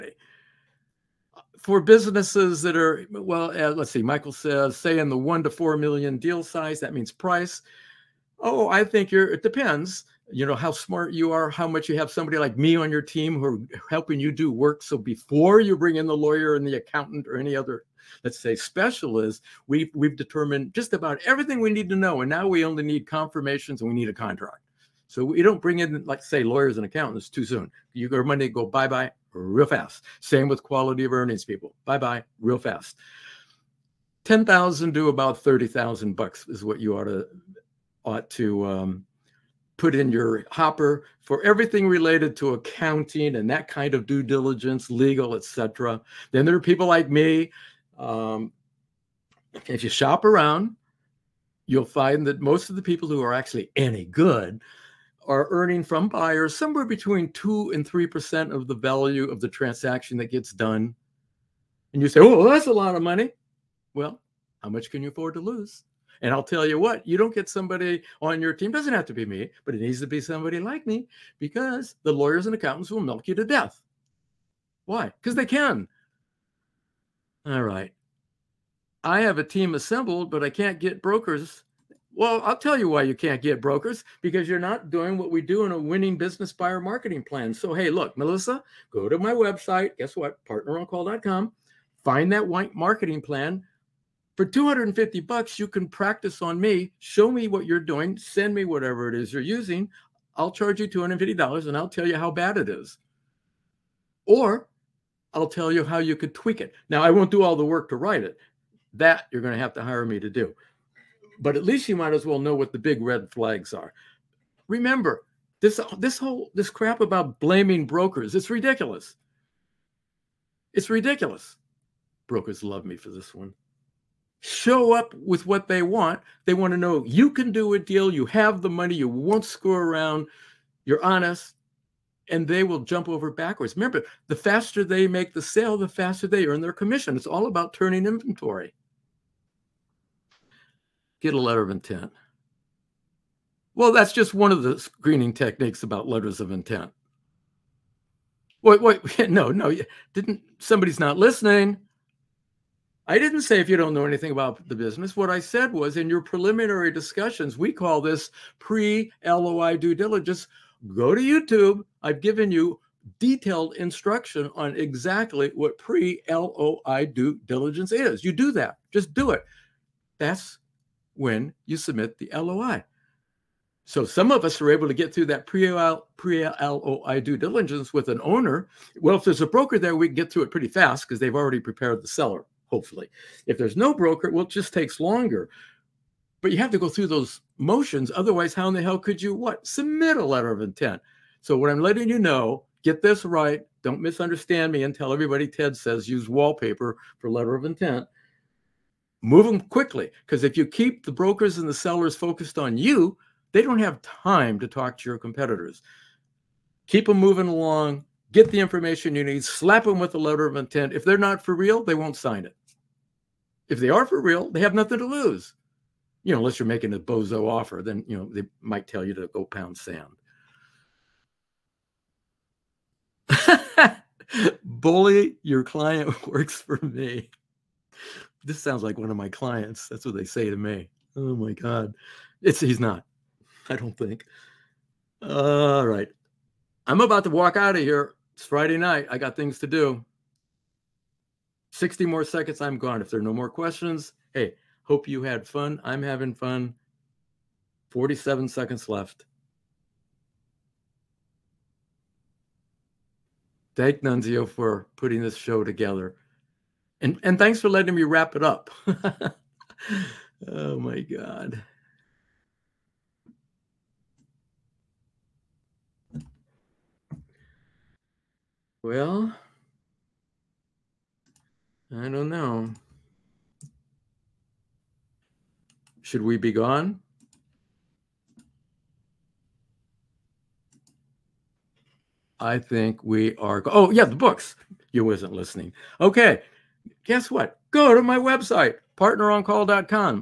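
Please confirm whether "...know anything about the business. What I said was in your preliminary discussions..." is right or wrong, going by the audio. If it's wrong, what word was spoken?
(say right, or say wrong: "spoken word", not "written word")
right.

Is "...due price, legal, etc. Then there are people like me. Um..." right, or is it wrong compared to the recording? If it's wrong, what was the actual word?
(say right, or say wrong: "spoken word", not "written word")
wrong: "diligence", not "price".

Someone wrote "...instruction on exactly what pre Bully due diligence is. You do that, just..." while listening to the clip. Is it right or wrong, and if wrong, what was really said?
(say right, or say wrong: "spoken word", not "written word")
wrong: "LOI", not "Bully".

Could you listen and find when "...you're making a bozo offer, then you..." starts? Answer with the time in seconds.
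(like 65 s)
216 s.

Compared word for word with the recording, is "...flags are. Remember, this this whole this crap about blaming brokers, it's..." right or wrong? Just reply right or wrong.
right.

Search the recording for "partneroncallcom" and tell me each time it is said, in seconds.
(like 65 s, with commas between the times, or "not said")
90 s, 288 s.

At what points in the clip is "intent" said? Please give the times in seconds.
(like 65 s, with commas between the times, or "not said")
141 s, 146 s, 190 s, 197 s, 210 s.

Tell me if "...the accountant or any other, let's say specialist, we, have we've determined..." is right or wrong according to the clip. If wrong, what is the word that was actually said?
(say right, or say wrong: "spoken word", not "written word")
right.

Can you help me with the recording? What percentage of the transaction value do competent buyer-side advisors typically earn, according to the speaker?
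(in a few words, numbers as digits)
2 to 3 percent.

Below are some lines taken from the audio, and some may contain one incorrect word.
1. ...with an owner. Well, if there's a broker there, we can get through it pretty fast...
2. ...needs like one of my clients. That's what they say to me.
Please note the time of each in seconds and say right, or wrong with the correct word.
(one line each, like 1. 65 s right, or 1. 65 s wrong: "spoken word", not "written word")
1. 177 s right
2. 228 s wrong: "sounds", not "needs".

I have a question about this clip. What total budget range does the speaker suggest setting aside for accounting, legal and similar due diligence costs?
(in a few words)
$10,000 to $30,000.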